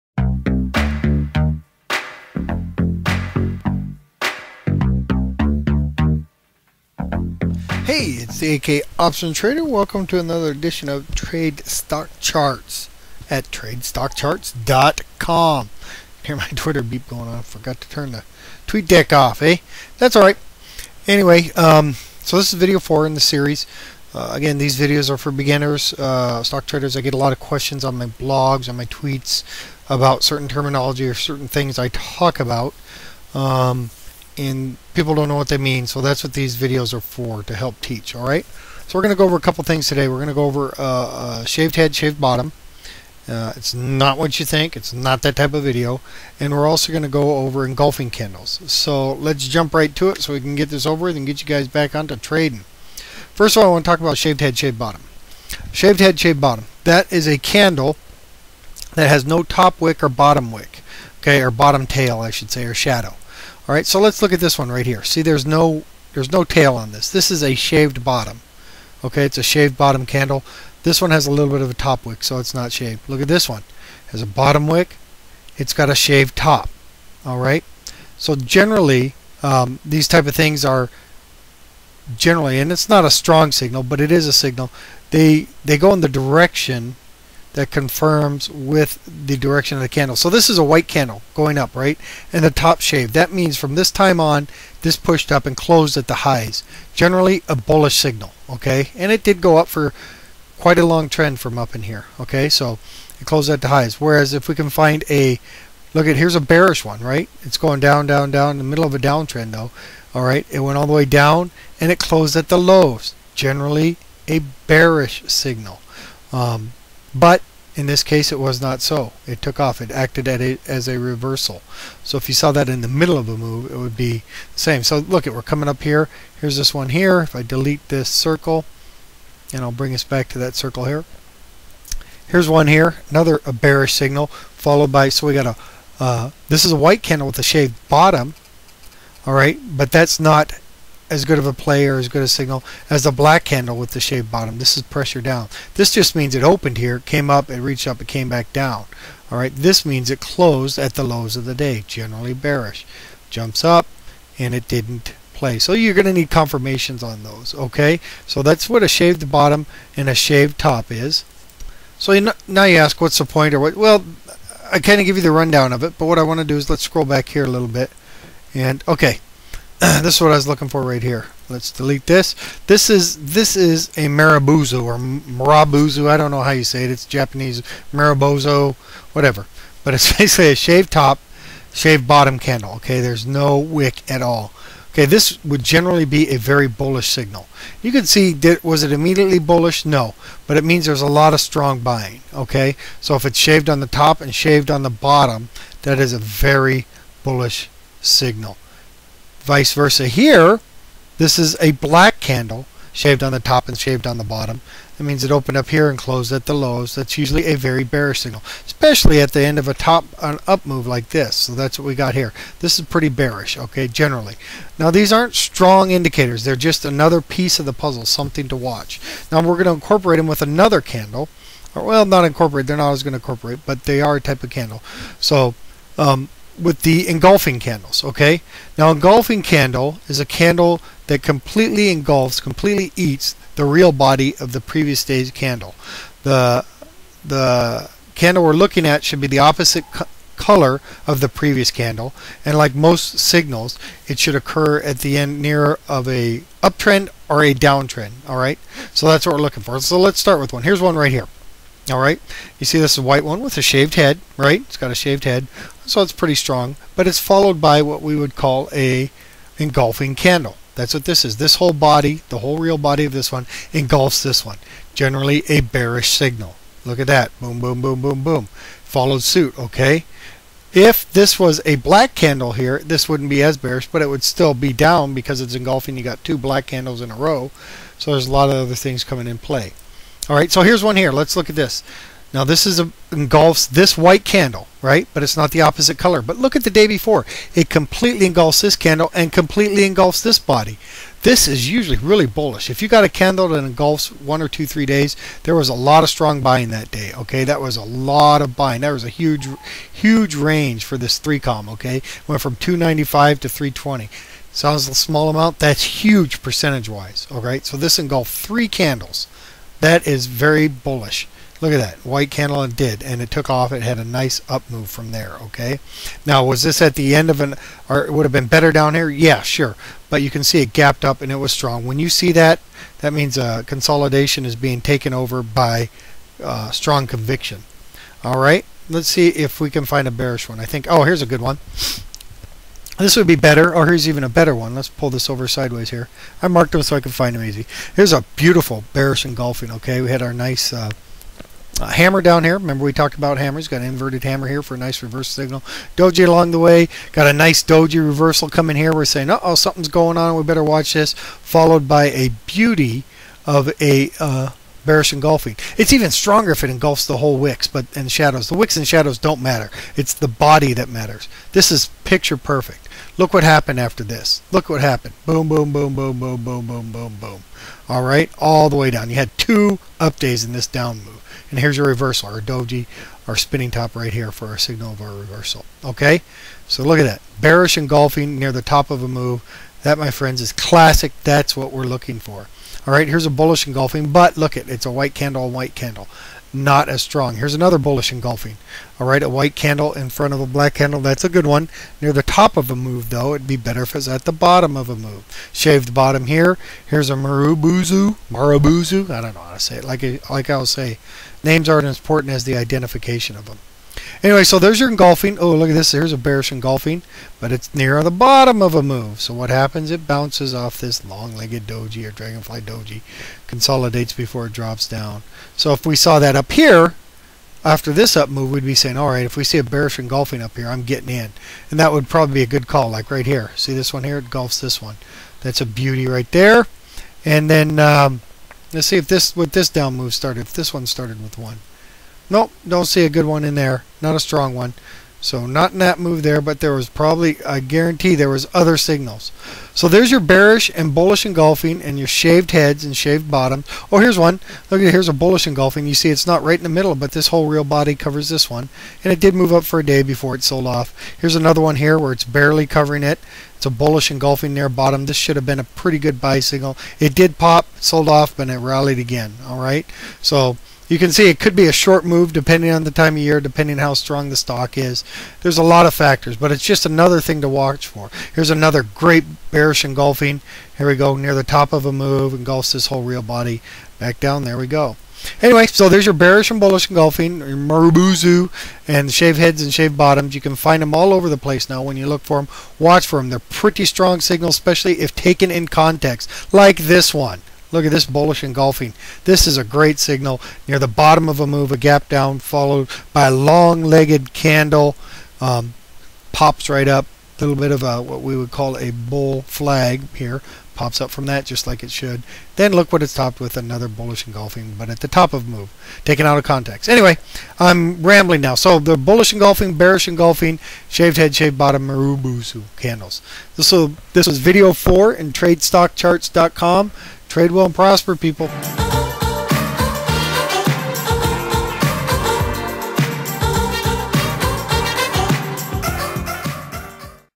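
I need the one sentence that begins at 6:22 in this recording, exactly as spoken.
All right, here's a bullish engulfing, but look it, it's a white candle, white candle.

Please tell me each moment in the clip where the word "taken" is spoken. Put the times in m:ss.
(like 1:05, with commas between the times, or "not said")
5:24, 8:05, 8:26.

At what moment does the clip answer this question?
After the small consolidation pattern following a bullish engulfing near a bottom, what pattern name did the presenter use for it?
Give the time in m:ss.
8:18.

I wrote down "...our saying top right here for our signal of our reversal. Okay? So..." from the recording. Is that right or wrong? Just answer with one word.
wrong.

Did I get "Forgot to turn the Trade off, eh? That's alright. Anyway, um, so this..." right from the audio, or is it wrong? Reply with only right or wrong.
wrong.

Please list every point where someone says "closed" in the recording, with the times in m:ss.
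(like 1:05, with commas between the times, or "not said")
1:35, 1:43, 1:51, 2:30, 3:25.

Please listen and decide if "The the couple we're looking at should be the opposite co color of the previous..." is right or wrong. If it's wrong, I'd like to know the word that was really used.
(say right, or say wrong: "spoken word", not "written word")
wrong: "candle", not "couple".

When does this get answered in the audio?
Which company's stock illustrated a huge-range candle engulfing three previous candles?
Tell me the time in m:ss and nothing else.
5:01.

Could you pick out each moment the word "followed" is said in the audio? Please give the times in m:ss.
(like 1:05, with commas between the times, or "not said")
2:14, 4:17, 4:28, 5:51, 8:12.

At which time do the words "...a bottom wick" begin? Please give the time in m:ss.
1:14.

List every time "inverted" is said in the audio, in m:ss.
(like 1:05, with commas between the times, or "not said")
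5:43.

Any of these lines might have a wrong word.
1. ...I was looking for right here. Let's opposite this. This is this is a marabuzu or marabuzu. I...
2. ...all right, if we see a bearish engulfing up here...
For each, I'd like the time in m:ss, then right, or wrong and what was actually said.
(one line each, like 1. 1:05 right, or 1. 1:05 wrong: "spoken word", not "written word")
1. 2:50 wrong: "delete", not "opposite"
2. 6:58 right.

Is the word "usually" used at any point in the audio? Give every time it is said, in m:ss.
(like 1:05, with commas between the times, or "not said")
3:27, 4:51.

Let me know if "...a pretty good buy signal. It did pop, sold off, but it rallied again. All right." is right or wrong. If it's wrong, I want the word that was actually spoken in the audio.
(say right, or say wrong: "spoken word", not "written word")
right.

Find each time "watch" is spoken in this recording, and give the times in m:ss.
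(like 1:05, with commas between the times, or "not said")
3:38, 5:50, 7:47, 8:02.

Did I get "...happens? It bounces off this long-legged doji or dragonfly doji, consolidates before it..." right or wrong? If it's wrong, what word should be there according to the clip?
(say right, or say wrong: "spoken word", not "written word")
right.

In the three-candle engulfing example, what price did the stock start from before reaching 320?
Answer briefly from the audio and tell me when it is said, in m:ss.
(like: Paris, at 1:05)
295, at 5:02.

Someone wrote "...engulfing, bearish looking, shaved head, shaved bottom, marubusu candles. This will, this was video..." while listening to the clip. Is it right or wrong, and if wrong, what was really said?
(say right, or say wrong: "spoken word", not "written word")
wrong: "engulfing", not "looking".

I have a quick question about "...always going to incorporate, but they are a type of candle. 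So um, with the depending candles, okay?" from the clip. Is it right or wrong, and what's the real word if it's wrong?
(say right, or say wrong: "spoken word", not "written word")
wrong: "engulfing", not "depending".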